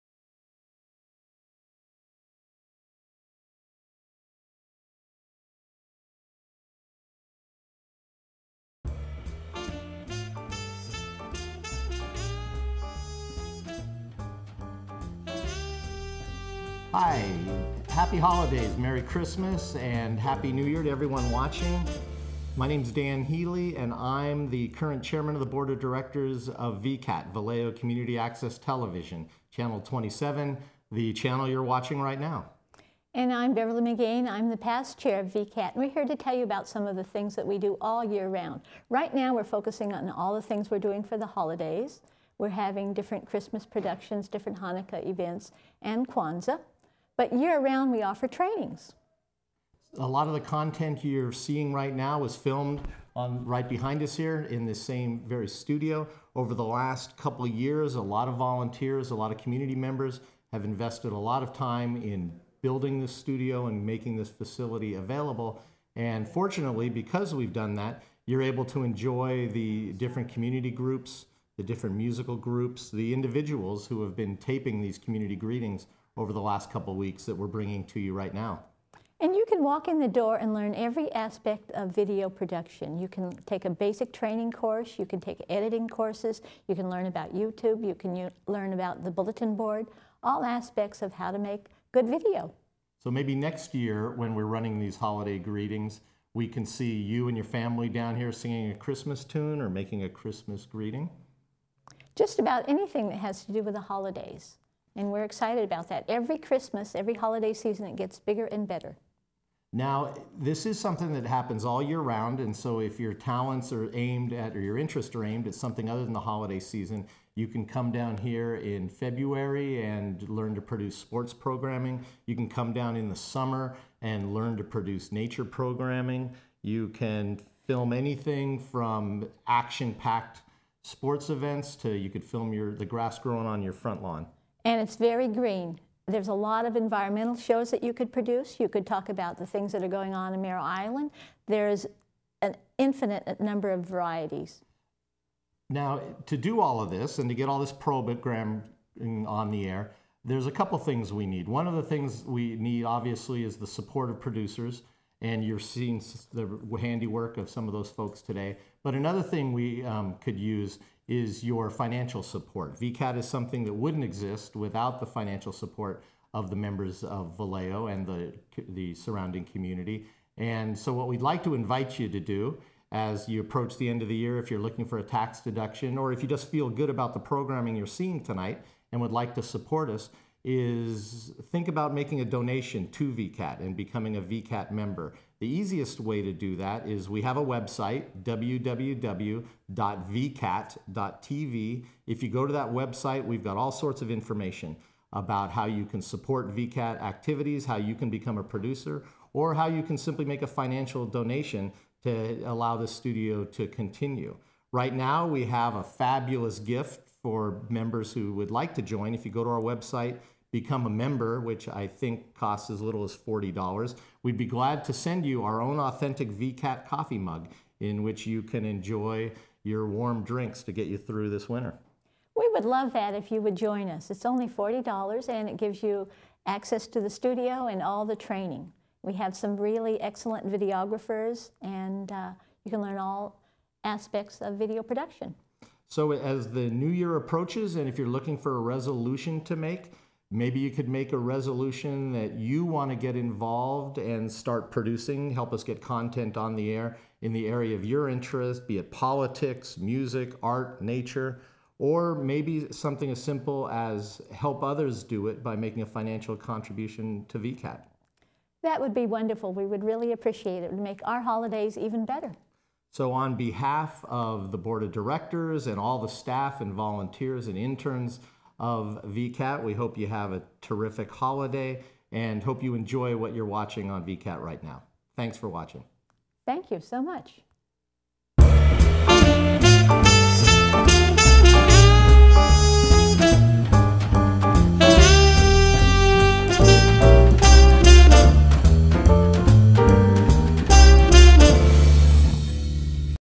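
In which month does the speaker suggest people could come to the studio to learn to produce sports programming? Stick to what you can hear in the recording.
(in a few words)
February.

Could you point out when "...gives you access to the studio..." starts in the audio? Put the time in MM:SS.
03:45.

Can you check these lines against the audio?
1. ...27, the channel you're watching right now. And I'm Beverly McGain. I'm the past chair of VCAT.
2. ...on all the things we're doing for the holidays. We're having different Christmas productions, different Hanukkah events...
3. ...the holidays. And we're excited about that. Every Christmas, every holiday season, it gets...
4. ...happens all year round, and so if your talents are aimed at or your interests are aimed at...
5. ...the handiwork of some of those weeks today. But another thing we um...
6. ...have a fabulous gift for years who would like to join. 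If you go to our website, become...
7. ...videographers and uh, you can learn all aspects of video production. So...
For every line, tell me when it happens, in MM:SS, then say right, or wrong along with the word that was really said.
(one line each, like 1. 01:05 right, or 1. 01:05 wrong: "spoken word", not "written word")
1. 00:29 right
2. 00:39 right
3. 01:43 right
4. 01:51 right
5. 02:36 wrong: "folks", not "weeks"
6. 03:25 wrong: "members", not "years"
7. 03:50 right.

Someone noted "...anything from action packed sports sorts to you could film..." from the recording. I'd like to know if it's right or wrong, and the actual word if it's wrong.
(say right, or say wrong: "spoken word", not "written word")
wrong: "events", not "sorts".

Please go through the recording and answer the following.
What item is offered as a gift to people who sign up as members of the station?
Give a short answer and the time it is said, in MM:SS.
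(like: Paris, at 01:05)
coffee mug, at 03:36.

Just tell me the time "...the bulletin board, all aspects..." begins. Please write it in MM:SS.
01:29.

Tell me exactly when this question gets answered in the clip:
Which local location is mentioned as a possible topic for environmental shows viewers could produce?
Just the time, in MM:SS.
02:20.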